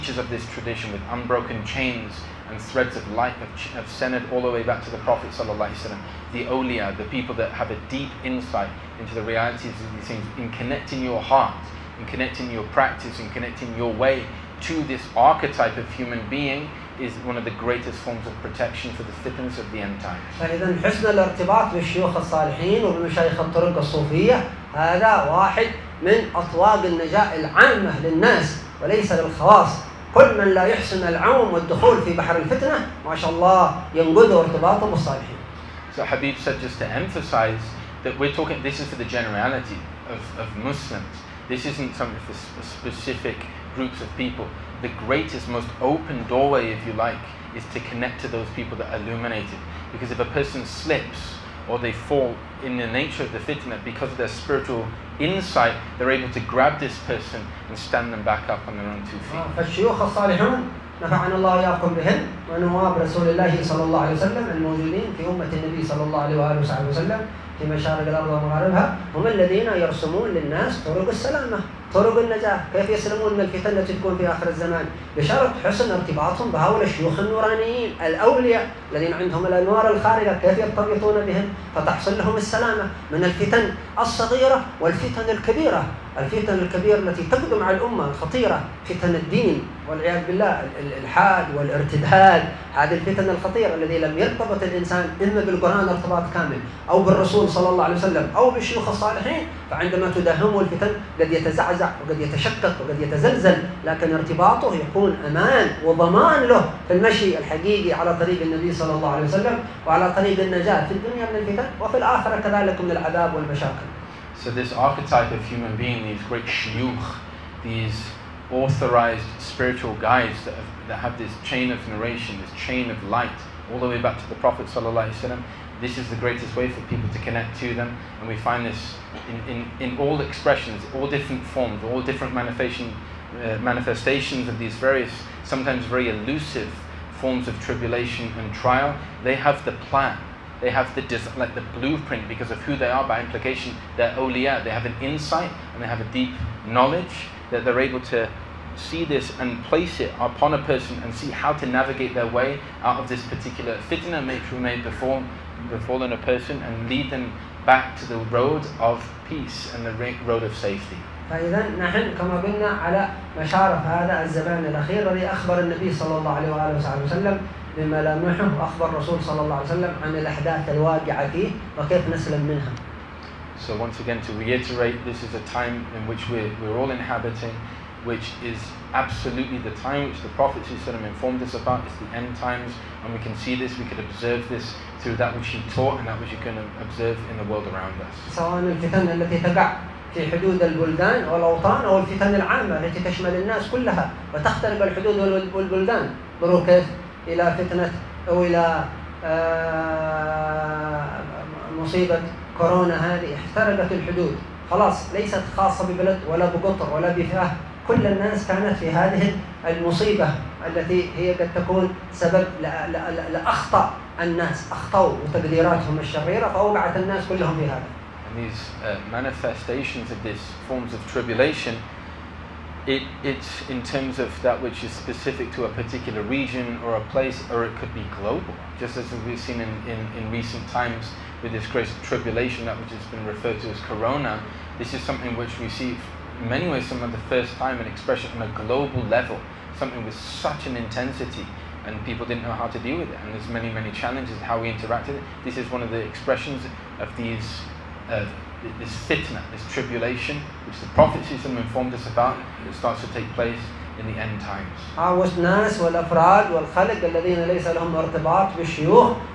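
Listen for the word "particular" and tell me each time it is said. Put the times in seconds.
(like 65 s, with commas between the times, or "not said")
153 s, 225 s.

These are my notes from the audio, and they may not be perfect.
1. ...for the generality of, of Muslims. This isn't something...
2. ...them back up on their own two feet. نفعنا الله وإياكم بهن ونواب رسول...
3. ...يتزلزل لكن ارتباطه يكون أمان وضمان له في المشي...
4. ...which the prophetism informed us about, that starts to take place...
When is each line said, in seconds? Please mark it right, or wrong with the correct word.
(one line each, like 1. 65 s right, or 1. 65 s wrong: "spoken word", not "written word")
1. 38 s right
2. 58 s right
3. 102 s right
4. 250 s right.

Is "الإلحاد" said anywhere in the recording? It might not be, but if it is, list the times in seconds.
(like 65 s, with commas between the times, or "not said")
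90 s.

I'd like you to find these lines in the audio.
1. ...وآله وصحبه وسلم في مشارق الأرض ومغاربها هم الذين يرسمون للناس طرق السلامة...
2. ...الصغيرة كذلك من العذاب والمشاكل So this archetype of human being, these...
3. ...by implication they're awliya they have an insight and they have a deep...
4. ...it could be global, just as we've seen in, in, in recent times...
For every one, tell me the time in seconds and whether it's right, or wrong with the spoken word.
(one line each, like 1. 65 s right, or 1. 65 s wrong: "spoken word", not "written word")
1. 66 s right
2. 111 s wrong: "الآخرة", not "الصغيرة"
3. 143 s right
4. 227 s right.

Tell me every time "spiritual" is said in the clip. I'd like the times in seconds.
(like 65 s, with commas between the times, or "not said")
54 s, 119 s.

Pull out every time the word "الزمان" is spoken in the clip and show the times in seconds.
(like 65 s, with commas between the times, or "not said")
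74 s, 164 s.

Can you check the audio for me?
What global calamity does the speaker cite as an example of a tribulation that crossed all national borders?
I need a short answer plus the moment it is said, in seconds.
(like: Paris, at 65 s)
Corona, at 233 s.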